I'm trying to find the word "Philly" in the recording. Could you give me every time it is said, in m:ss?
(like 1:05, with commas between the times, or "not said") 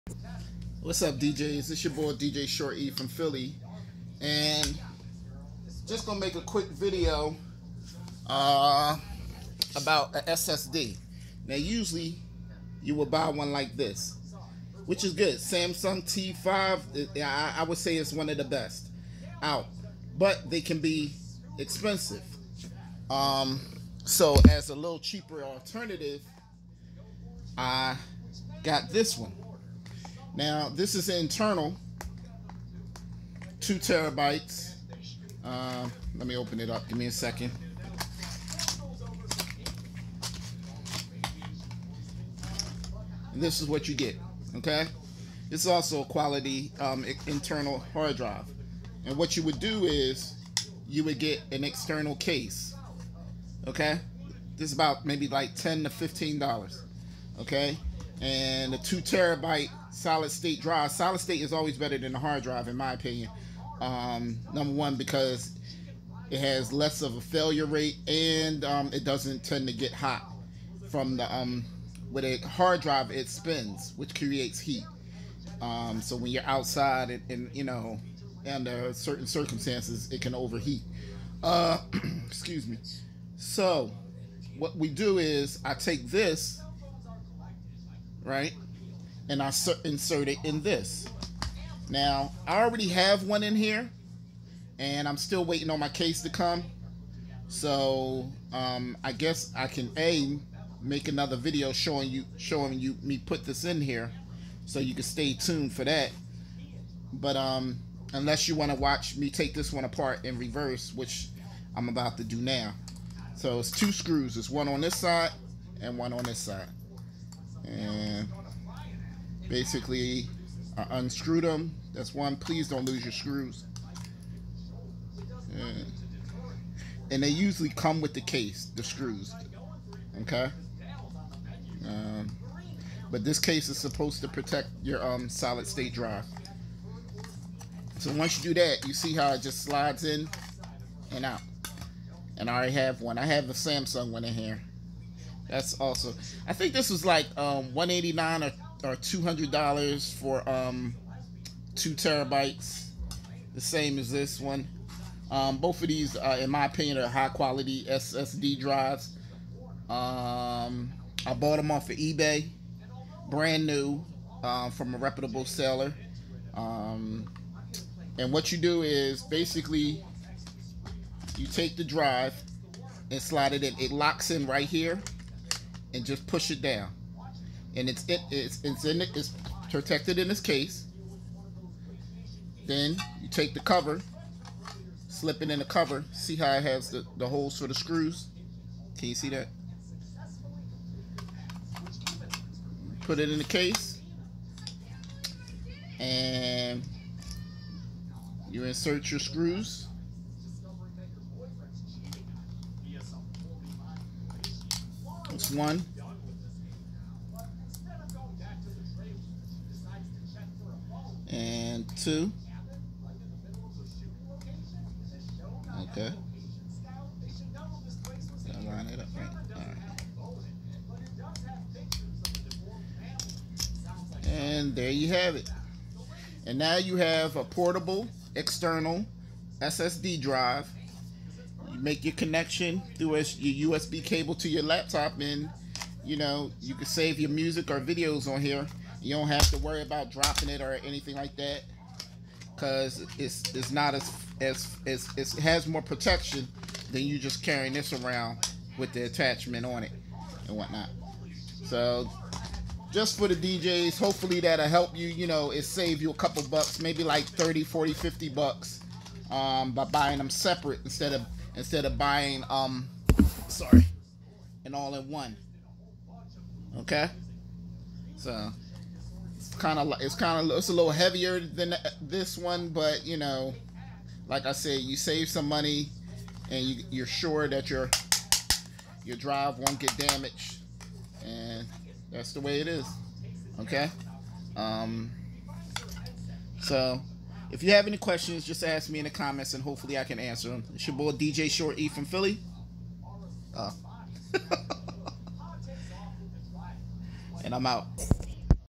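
0:03, 4:52.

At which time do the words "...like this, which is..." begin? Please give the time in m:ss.
0:13.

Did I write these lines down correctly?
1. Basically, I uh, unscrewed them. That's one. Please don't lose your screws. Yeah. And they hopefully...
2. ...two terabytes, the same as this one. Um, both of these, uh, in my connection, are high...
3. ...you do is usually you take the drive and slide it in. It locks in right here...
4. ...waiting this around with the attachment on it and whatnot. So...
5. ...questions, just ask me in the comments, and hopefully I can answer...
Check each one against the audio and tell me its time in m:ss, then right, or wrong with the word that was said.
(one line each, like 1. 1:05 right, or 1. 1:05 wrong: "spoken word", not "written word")
1. 1:59 wrong: "usually", not "hopefully"
2. 2:31 wrong: "opinion", not "connection"
3. 2:48 wrong: "basically", not "usually"
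4. 4:07 wrong: "carrying", not "waiting"
5. 4:47 right.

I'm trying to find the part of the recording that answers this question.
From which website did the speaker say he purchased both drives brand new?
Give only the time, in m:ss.
2:41.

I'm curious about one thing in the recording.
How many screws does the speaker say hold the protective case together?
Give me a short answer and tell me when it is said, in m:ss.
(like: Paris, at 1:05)
2, at 1:53.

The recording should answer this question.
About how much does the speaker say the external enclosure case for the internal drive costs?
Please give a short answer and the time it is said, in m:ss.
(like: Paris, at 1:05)
$10 to $15, at 0:55.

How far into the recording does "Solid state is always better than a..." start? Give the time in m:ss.
1:00.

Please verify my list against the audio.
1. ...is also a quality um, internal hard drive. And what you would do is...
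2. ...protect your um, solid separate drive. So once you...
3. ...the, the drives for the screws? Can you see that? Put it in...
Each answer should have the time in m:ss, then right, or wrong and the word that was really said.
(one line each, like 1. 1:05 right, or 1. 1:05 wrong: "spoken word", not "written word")
1. 0:45 right
2. 2:14 wrong: "state", not "separate"
3. 3:06 wrong: "holes", not "drives".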